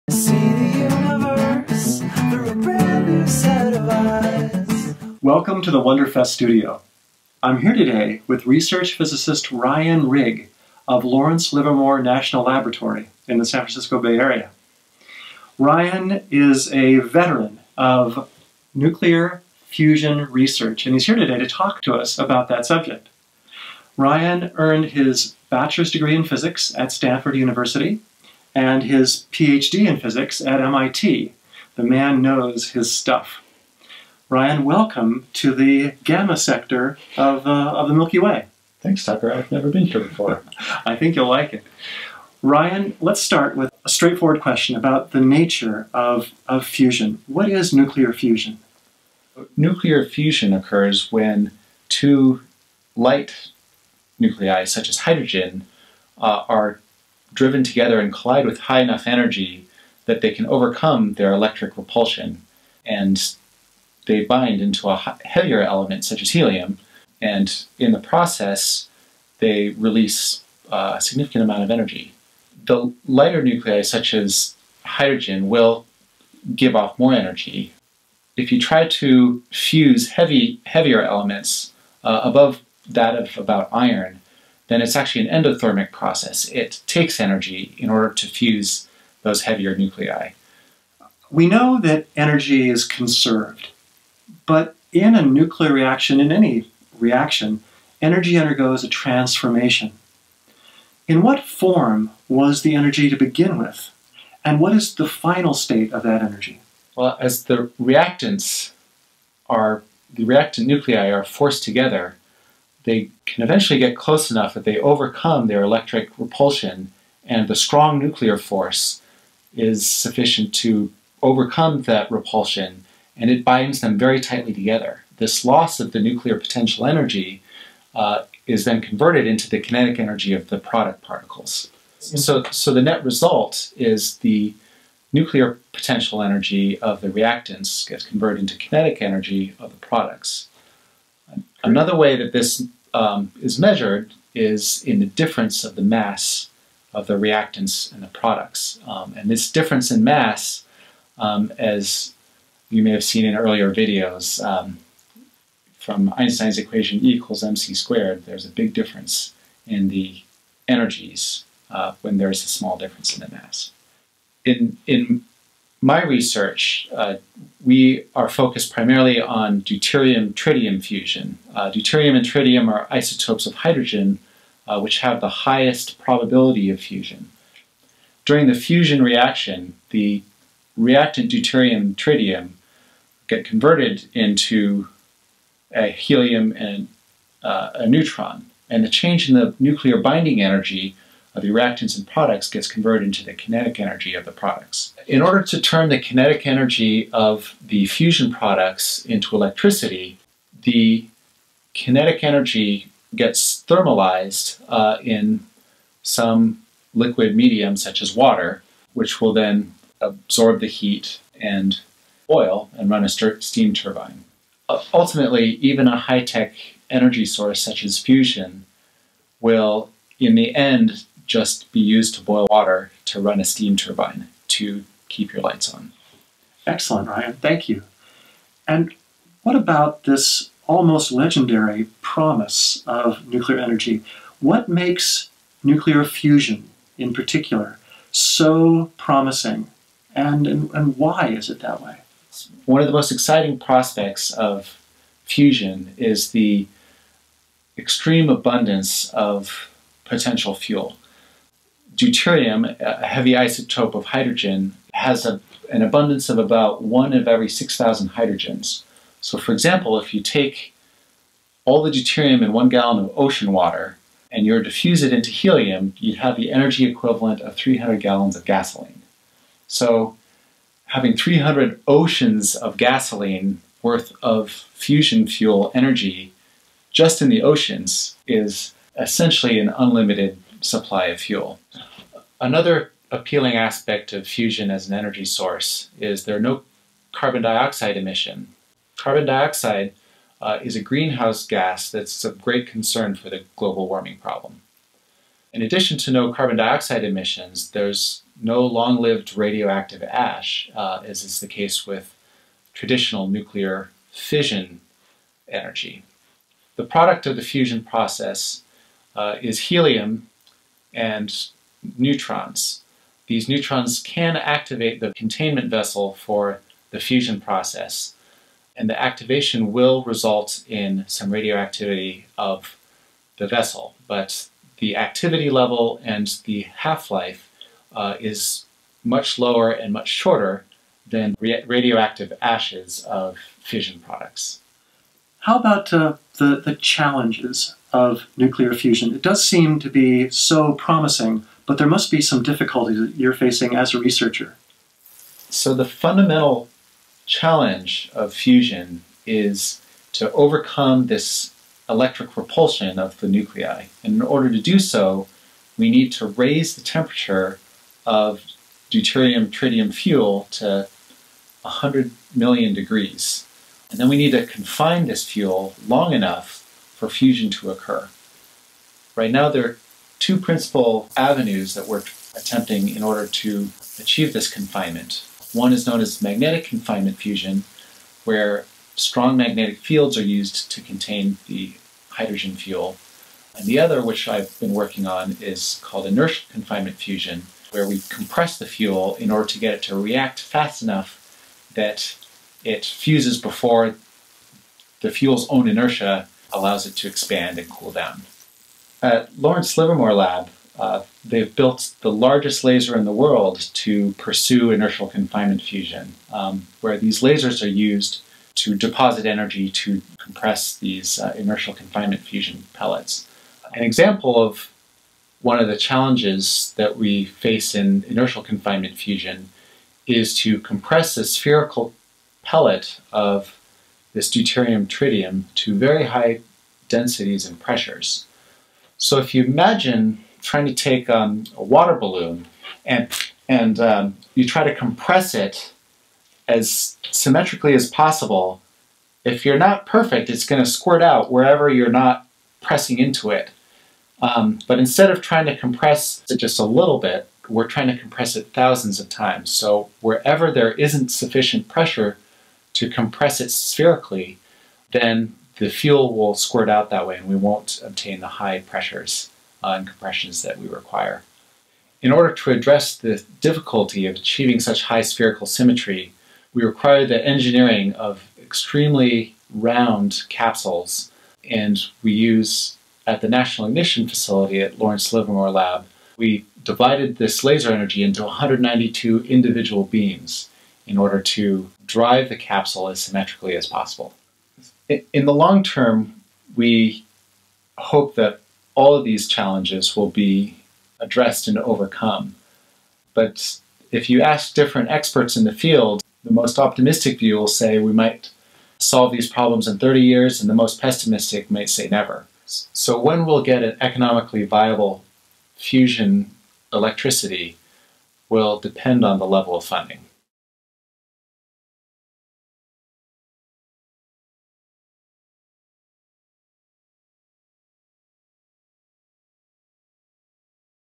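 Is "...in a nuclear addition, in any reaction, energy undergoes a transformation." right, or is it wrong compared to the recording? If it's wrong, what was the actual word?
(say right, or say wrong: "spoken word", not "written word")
wrong: "reaction", not "addition".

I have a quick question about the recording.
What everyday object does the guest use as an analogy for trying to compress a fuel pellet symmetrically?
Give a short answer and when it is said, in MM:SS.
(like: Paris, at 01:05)
water balloon, at 07:11.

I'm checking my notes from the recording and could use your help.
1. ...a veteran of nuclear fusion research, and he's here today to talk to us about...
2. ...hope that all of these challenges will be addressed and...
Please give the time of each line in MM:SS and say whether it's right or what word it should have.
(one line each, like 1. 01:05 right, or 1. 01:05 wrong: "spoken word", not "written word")
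1. 00:16 right
2. 08:07 right.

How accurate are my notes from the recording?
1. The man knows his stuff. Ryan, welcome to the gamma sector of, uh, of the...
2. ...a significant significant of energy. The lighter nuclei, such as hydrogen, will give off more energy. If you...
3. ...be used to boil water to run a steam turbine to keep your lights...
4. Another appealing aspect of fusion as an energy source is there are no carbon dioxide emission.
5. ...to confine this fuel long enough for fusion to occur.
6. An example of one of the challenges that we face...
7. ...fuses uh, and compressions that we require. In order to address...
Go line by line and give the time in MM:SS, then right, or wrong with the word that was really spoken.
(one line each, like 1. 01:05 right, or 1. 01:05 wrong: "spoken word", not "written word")
1. 00:31 right
2. 01:10 wrong: "amount", not "significant"
3. 03:41 right
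4. 04:42 right
5. 06:04 right
6. 06:53 right
7. 07:38 wrong: "pressures", not "fuses".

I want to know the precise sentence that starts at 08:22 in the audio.
So when we'll get an economically viable fusion electricity will depend on the level of funding.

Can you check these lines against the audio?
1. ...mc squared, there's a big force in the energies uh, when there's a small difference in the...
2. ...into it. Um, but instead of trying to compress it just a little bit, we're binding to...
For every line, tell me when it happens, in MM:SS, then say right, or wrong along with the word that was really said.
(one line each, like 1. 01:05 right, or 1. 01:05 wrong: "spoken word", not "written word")
1. 02:37 wrong: "difference", not "force"
2. 07:22 wrong: "trying", not "binding".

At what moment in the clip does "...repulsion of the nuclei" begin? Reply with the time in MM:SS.
05:52.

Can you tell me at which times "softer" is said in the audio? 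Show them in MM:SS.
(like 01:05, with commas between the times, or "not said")
not said.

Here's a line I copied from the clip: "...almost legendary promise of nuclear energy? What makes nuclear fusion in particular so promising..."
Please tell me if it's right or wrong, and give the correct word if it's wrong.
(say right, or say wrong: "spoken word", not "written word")
right.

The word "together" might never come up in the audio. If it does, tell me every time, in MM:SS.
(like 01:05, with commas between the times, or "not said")
00:57, 01:51, 02:04.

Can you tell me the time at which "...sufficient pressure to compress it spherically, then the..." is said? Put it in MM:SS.
07:31.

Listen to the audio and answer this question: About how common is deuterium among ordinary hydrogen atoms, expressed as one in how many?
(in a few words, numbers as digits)
1 in 6,000.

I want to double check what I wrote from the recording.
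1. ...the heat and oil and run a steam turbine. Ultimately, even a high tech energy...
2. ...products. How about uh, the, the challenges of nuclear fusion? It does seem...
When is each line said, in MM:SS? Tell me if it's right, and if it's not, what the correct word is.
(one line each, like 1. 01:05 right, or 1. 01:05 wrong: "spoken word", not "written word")
1. 03:30 right
2. 05:34 right.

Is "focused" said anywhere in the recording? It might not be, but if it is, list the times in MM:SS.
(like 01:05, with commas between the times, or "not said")
02:48.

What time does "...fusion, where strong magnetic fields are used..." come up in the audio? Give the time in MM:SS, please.
06:17.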